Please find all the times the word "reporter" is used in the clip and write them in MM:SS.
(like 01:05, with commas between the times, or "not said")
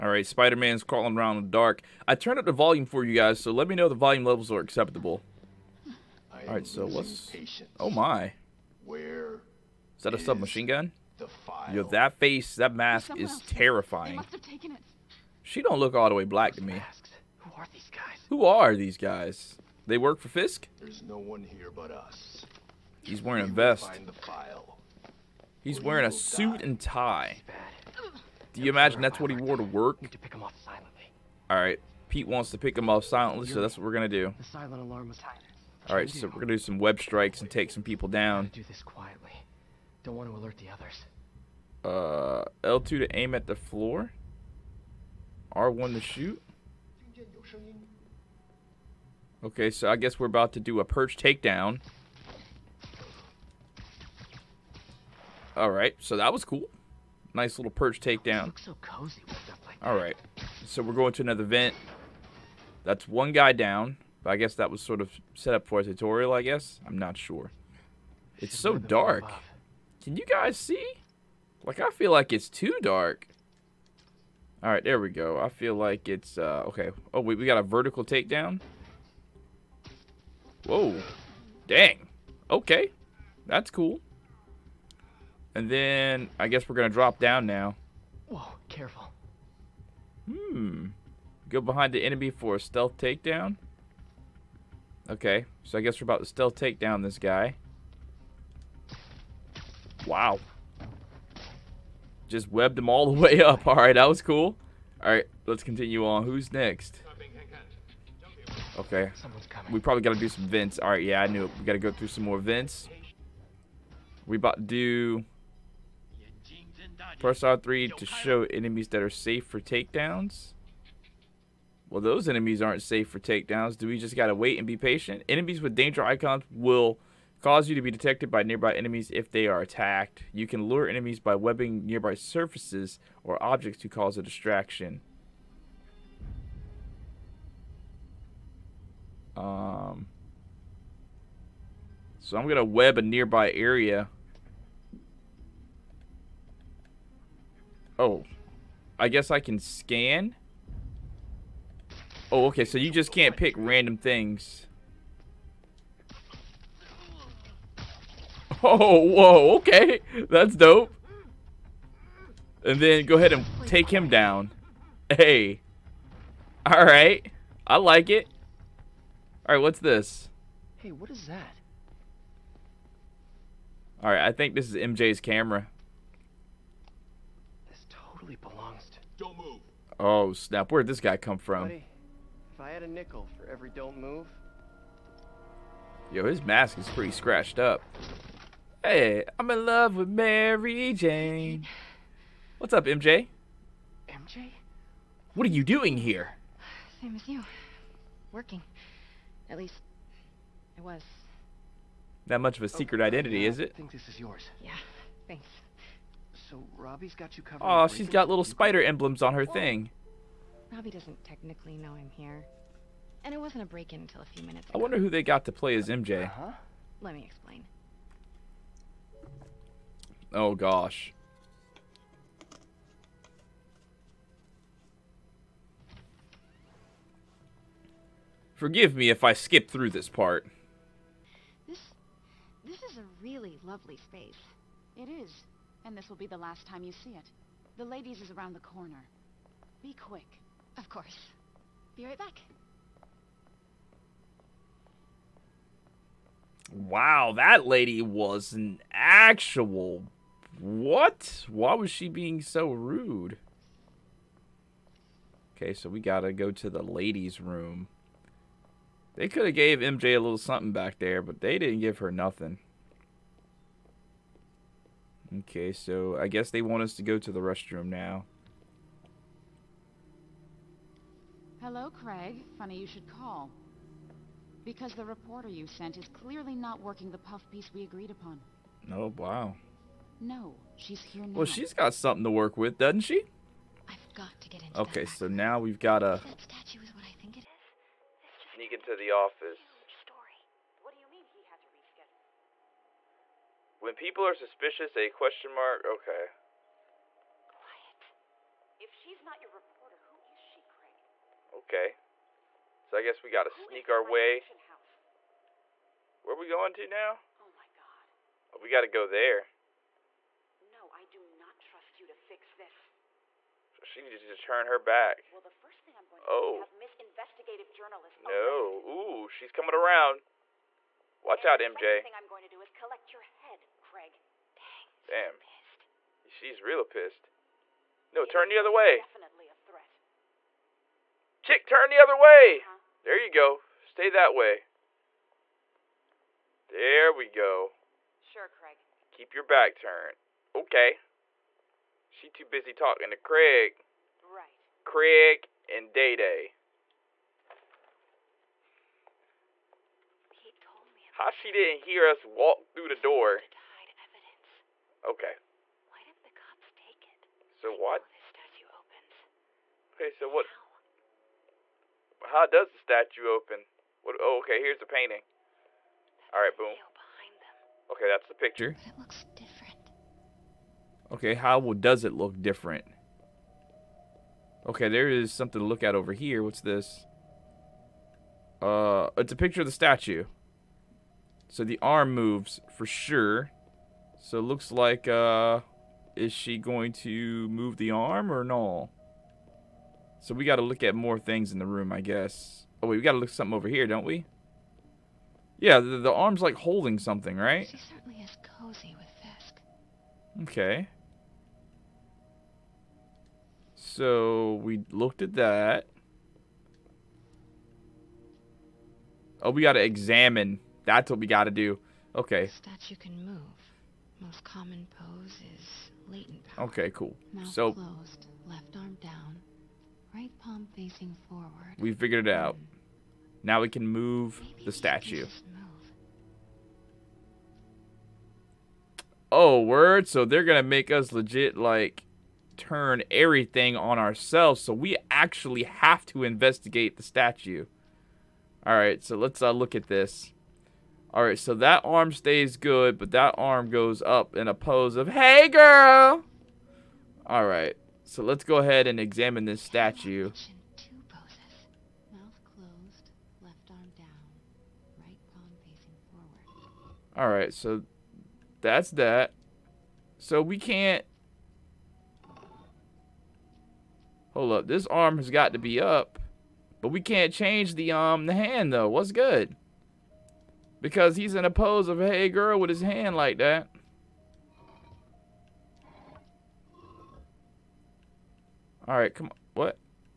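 04:35, 04:59.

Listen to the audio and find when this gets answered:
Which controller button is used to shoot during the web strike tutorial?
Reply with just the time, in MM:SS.
00:45.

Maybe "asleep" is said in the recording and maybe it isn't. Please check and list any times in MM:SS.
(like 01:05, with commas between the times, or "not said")
not said.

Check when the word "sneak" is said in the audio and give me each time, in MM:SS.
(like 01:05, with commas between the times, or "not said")
04:48, 05:03.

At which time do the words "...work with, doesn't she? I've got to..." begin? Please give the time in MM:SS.
04:42.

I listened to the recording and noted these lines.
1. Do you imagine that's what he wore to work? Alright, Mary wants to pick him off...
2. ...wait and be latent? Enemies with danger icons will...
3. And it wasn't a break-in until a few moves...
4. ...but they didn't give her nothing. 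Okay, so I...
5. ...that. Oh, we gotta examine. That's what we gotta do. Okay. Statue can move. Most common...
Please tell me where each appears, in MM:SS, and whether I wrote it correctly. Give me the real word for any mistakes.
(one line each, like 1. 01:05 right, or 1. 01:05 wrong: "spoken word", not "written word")
1. 00:28 wrong: "Pete", not "Mary"
2. 02:04 wrong: "patient", not "latent"
3. 03:33 wrong: "minutes", not "moves"
4. 04:21 right
5. 06:45 right.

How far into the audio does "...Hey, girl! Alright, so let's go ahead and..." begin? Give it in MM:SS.
07:25.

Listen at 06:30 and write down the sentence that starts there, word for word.
So we got to look at more things in the room, I guess.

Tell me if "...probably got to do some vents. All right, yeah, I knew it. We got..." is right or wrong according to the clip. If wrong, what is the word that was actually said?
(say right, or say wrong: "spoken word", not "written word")
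right.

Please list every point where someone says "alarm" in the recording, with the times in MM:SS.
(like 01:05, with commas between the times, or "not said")
00:34.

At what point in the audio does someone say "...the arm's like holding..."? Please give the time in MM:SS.
06:35.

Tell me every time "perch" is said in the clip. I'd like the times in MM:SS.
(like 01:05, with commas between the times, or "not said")
00:50, 00:57.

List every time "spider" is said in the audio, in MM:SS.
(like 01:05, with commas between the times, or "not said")
00:00, 03:28.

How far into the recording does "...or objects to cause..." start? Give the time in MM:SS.
02:13.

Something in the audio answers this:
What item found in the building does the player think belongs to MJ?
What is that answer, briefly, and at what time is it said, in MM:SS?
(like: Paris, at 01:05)
MJ's camera, at 02:54.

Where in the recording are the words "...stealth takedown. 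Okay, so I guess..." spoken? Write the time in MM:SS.
01:32.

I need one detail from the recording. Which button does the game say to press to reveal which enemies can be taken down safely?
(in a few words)
R3.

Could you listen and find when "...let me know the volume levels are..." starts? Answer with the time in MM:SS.
00:03.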